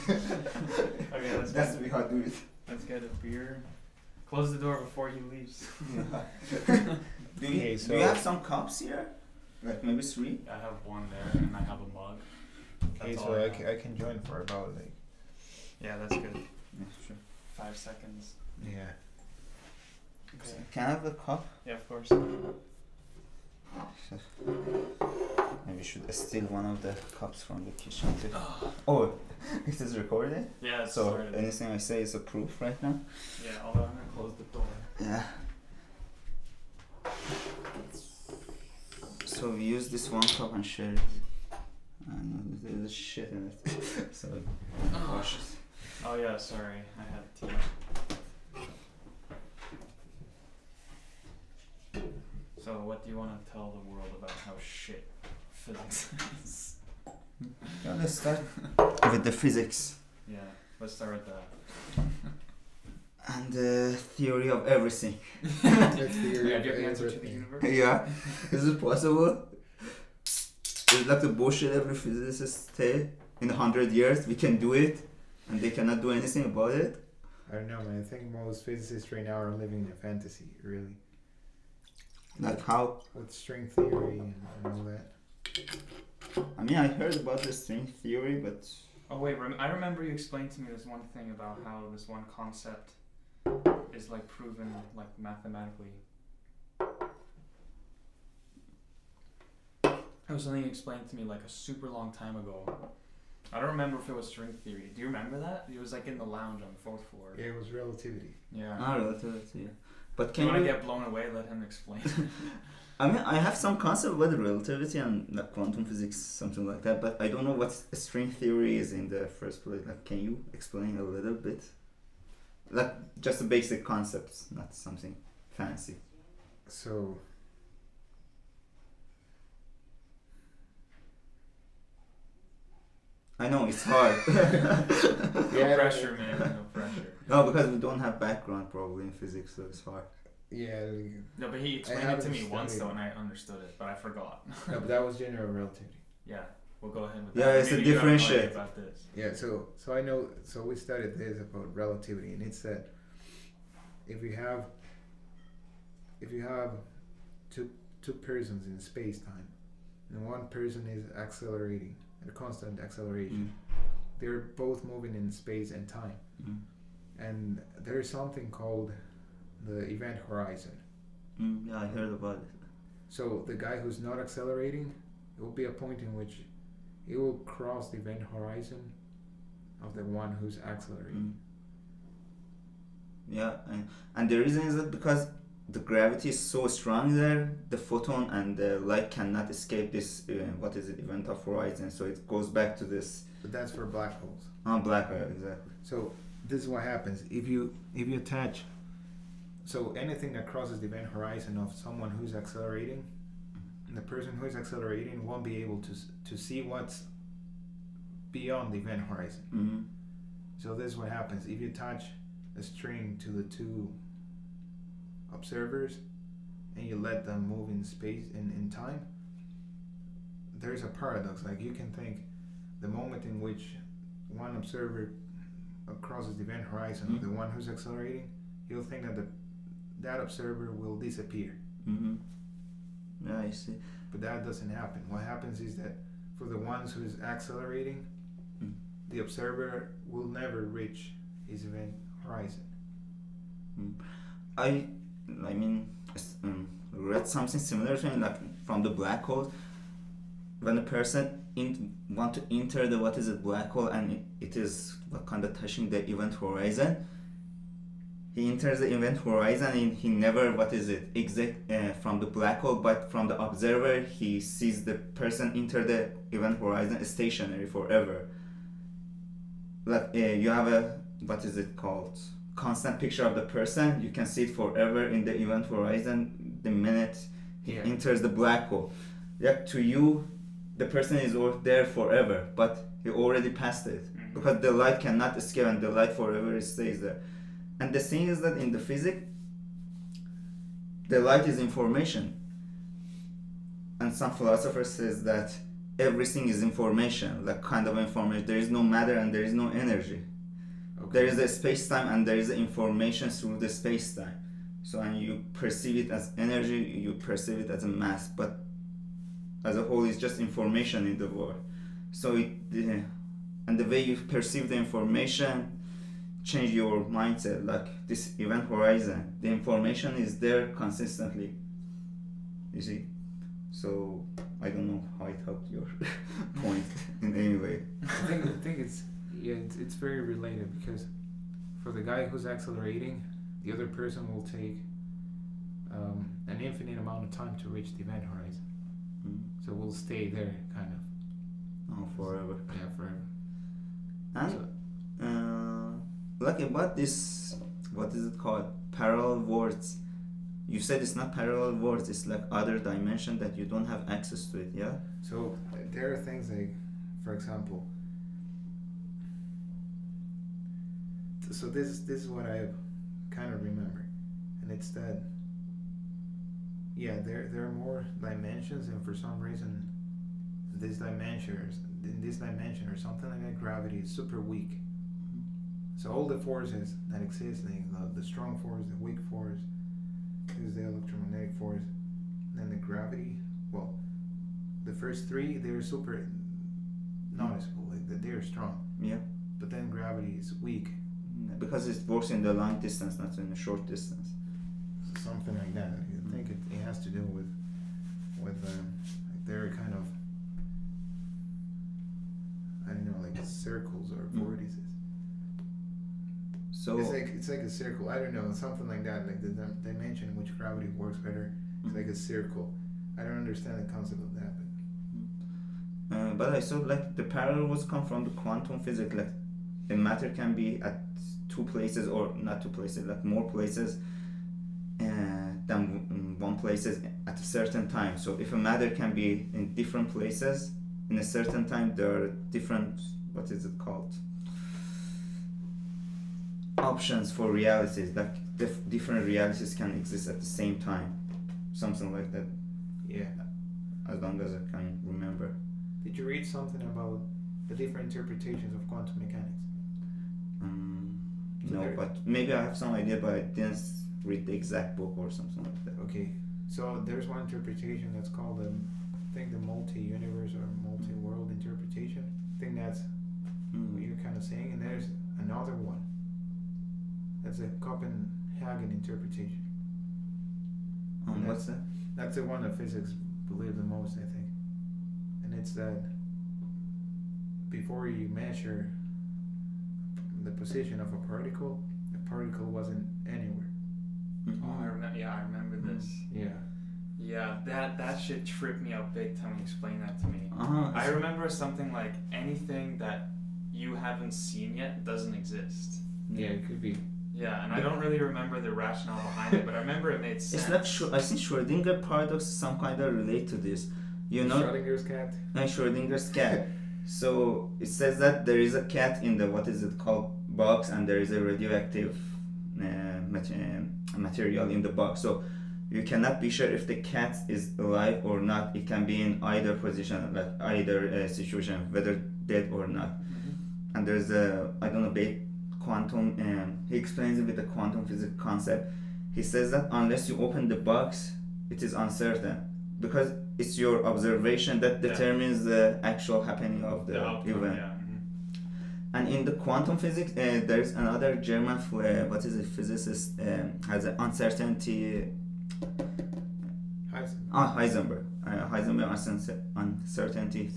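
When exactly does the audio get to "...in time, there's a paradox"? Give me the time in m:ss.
3:38.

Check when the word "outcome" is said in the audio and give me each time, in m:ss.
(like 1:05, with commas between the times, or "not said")
8:57.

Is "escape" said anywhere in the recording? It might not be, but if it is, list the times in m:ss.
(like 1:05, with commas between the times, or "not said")
3:09, 4:45.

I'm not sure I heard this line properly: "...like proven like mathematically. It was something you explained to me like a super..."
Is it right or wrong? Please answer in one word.
right.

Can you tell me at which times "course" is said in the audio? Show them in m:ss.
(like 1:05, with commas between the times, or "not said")
0:21.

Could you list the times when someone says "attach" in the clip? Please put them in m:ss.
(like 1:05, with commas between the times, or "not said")
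3:18, 3:31.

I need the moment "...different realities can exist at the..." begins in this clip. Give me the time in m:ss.
7:18.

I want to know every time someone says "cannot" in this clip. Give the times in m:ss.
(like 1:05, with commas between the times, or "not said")
1:15, 3:09, 4:44, 8:36.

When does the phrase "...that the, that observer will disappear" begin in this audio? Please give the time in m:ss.
3:49.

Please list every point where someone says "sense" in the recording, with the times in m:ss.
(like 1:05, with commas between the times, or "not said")
8:20.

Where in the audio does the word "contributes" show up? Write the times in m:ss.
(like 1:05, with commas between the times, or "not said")
not said.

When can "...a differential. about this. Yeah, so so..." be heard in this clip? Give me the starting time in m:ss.
2:27.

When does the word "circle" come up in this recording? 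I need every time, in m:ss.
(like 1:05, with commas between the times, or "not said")
6:43, 6:47, 6:52.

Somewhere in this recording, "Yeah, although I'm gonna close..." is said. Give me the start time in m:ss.
0:33.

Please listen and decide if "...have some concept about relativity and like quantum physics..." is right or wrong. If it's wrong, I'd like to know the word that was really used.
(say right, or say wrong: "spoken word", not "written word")
right.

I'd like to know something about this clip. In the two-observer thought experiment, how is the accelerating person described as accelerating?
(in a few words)
Constant acceleration.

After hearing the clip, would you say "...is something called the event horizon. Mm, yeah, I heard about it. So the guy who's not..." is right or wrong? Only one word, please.
right.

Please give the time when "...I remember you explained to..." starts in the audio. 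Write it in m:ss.
1:29.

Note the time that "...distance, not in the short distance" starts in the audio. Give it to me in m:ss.
6:32.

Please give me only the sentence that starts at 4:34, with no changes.
You can see it forever in the event horizon the minute he yeah.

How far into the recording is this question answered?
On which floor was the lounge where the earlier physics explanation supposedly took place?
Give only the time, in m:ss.
1:46.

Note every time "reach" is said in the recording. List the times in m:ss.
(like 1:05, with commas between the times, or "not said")
4:00, 5:37.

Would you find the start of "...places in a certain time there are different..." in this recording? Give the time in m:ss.
7:10.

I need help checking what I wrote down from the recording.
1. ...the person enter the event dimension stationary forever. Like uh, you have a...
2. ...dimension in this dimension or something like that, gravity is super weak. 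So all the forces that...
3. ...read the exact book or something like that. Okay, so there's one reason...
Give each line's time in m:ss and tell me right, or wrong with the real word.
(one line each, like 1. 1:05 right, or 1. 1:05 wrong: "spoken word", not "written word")
1. 4:24 wrong: "horizon", not "dimension"
2. 6:10 right
3. 7:34 wrong: "interpretation", not "reason".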